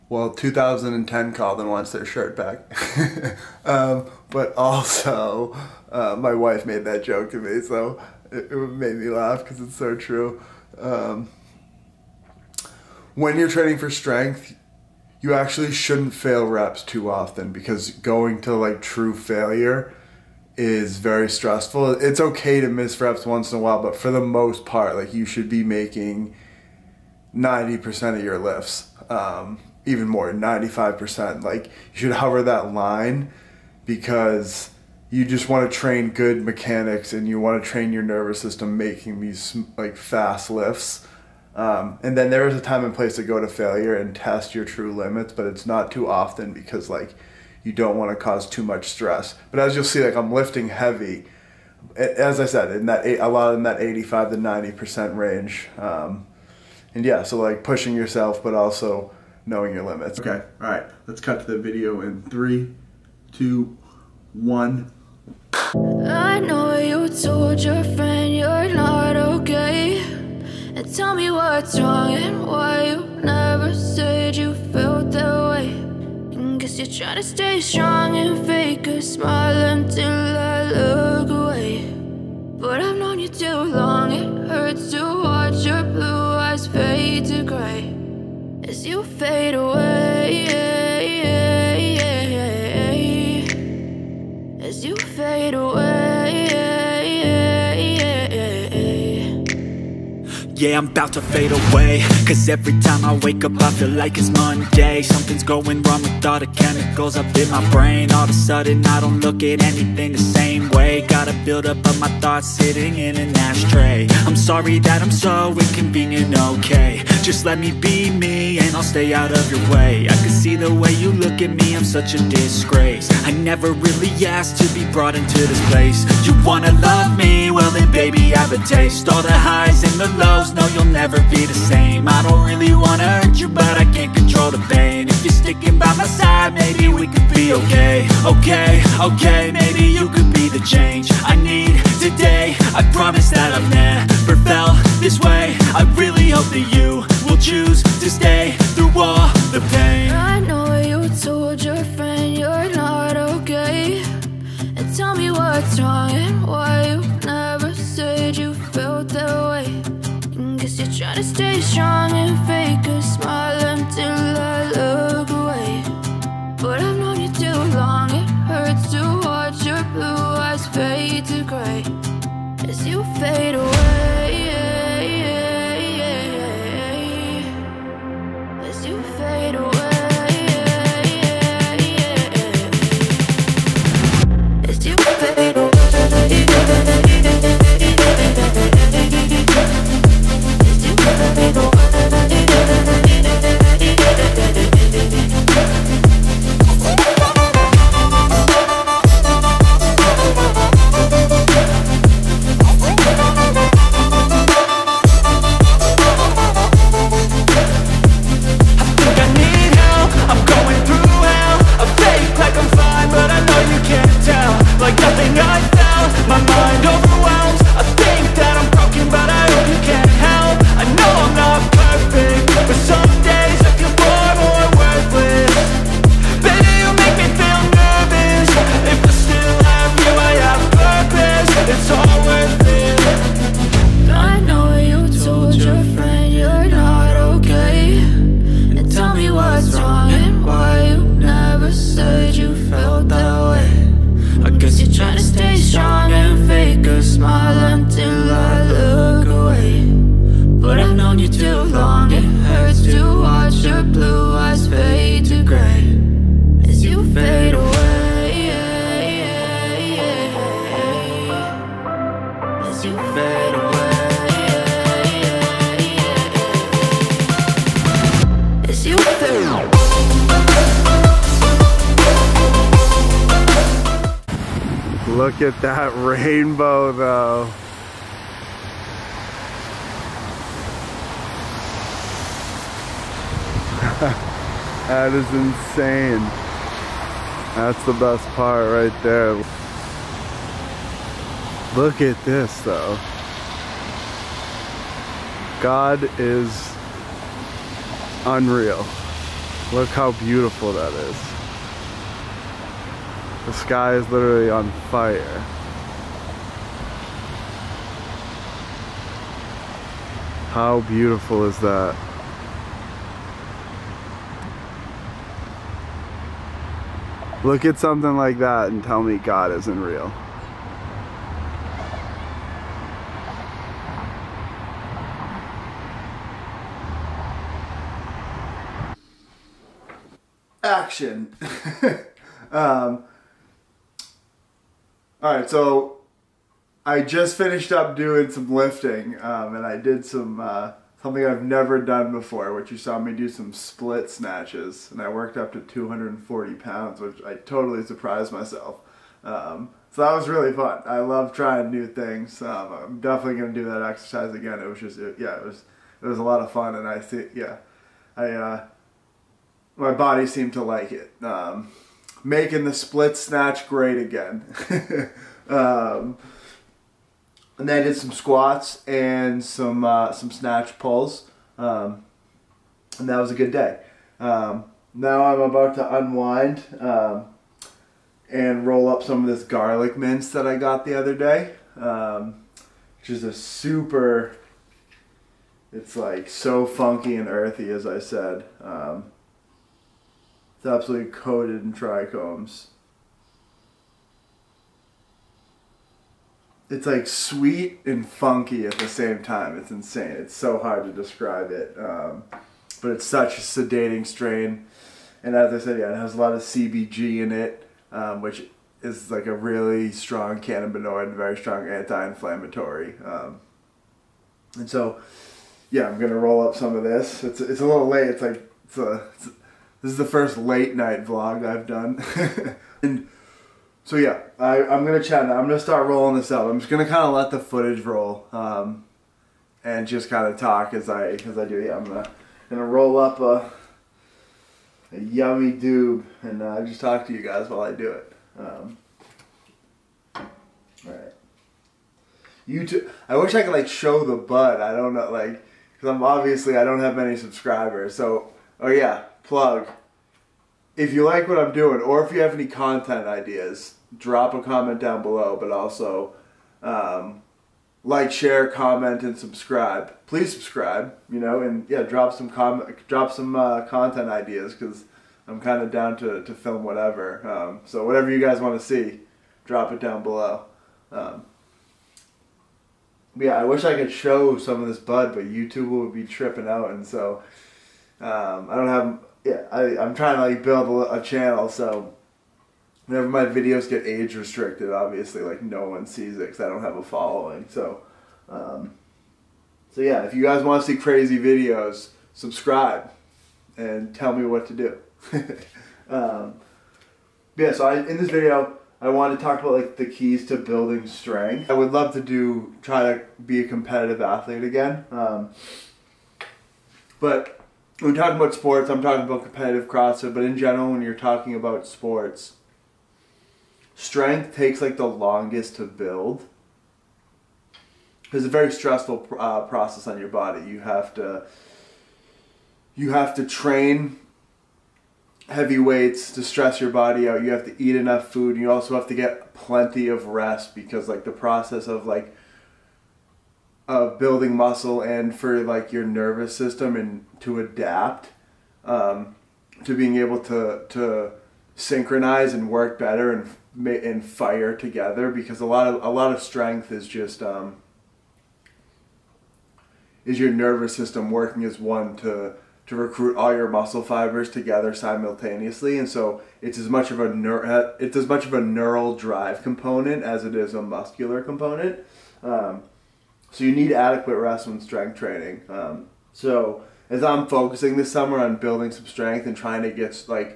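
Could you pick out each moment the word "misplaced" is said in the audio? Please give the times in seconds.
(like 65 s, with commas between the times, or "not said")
not said.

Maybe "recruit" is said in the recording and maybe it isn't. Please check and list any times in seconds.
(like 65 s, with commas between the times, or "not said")
552 s.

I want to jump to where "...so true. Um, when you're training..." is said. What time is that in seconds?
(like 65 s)
9 s.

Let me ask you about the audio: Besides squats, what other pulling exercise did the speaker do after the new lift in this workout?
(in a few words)
snatch pulls.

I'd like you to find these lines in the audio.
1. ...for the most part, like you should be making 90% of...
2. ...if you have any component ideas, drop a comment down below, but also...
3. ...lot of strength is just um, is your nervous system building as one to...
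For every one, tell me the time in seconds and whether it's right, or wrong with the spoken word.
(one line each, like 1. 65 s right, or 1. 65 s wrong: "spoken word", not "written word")
1. 23 s right
2. 452 s wrong: "content", not "component"
3. 545 s wrong: "working", not "building".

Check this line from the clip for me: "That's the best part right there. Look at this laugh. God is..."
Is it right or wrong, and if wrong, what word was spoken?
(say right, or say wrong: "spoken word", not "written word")
wrong: "though", not "laugh".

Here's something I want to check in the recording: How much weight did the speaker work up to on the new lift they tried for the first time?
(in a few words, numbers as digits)
240 pounds.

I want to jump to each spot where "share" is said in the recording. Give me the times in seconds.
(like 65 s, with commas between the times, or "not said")
458 s.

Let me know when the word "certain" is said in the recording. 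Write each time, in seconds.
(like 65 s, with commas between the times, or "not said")
not said.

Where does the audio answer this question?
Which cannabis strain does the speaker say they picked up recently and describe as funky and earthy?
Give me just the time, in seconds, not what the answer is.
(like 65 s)
379 s.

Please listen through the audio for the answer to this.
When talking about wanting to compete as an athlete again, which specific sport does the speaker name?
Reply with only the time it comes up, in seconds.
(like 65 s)
509 s.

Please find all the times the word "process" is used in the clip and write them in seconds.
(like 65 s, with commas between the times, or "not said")
519 s, 531 s.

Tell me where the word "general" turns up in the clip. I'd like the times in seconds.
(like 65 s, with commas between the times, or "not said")
510 s.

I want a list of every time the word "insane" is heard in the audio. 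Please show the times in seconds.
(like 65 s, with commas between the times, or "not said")
285 s, 399 s.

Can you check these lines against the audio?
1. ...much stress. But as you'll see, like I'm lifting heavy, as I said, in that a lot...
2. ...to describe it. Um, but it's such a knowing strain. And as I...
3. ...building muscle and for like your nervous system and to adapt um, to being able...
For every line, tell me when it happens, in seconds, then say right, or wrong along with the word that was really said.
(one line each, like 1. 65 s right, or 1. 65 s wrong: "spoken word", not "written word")
1. 48 s right
2. 400 s wrong: "sedating", not "knowing"
3. 533 s right.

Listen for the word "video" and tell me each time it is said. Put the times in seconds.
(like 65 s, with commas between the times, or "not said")
61 s, 483 s, 491 s, 498 s.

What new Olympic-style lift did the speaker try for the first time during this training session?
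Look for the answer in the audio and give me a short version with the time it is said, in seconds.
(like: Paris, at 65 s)
split snatches, at 343 s.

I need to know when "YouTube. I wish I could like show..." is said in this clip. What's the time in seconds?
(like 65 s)
442 s.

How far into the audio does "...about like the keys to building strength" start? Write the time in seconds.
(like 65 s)
499 s.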